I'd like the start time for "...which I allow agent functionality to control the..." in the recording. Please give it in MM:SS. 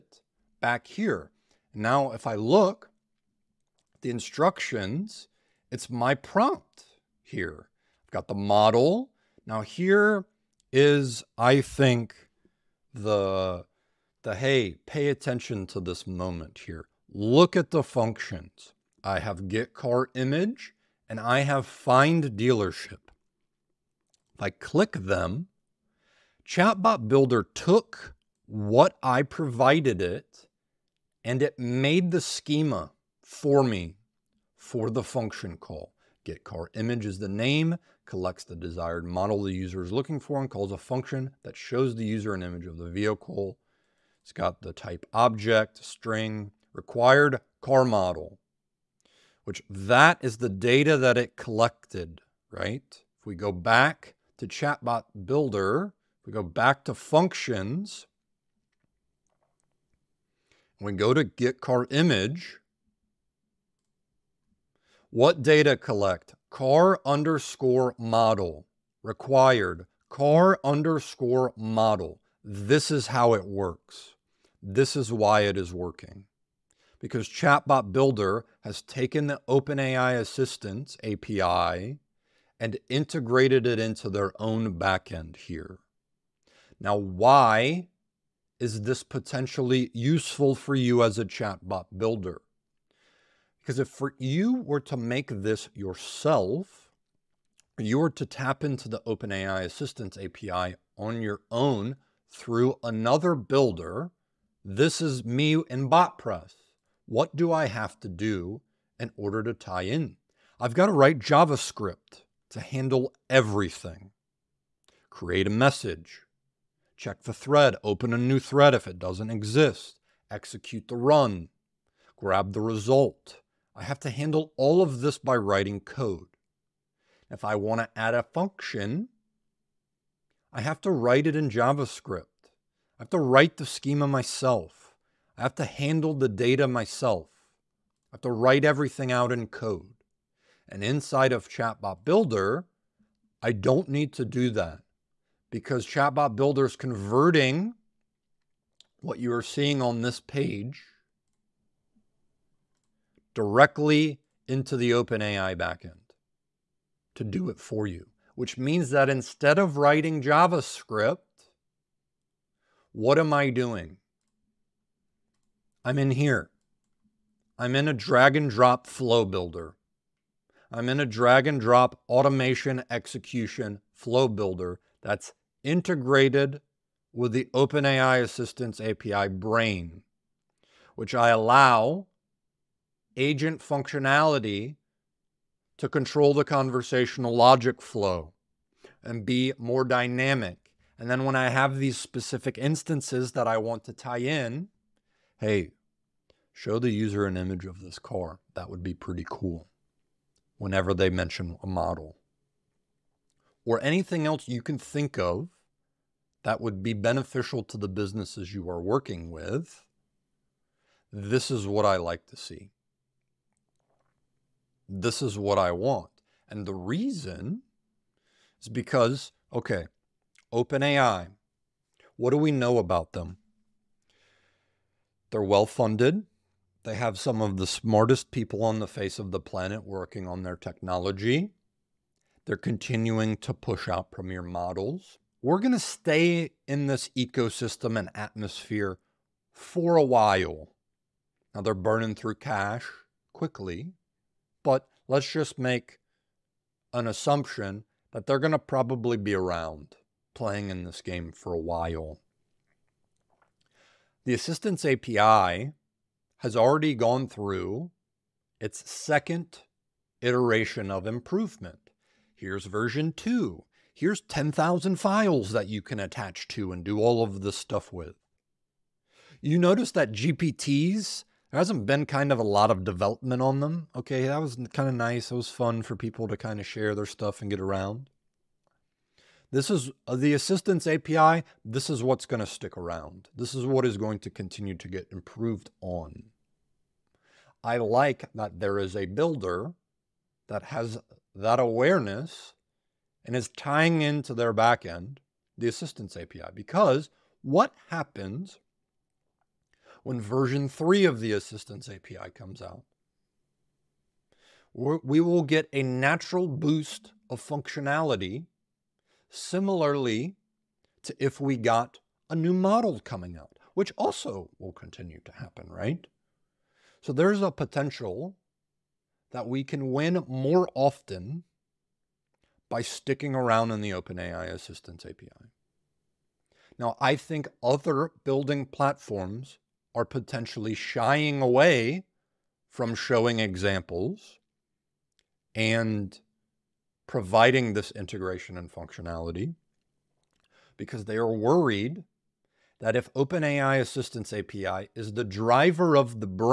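03:00.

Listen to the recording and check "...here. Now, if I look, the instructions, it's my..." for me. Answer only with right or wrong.
right.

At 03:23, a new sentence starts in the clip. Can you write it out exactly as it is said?
Or anything else you can think of that would be beneficial to the businesses you are working with.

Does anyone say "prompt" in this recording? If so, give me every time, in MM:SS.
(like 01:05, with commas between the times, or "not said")
00:06.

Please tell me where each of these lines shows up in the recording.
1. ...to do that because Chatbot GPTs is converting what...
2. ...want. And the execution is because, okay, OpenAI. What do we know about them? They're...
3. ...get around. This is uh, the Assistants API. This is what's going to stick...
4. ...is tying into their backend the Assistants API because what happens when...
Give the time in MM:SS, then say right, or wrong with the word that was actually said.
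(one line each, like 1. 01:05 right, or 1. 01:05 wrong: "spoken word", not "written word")
1. 02:24 wrong: "Builder", not "GPTs"
2. 03:35 wrong: "reason", not "execution"
3. 04:37 right
4. 04:53 right.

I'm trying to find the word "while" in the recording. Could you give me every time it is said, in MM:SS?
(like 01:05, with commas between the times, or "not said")
04:00, 04:11.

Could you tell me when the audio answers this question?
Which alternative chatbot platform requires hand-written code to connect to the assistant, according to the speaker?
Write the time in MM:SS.
01:45.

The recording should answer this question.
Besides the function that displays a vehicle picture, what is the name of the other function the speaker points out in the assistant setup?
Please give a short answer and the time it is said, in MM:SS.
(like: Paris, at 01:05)
find dealership, at 00:21.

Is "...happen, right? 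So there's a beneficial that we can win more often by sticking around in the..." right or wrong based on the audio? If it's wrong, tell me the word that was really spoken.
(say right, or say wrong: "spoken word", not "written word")
wrong: "potential", not "beneficial".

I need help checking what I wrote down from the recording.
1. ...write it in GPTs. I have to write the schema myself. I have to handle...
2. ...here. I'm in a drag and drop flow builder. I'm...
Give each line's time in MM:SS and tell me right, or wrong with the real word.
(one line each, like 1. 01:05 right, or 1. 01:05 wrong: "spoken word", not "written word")
1. 02:10 wrong: "JavaScript", not "GPTs"
2. 02:46 right.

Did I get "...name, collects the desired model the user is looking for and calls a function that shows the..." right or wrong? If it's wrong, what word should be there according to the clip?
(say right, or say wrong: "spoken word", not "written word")
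right.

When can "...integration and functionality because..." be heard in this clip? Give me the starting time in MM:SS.
05:37.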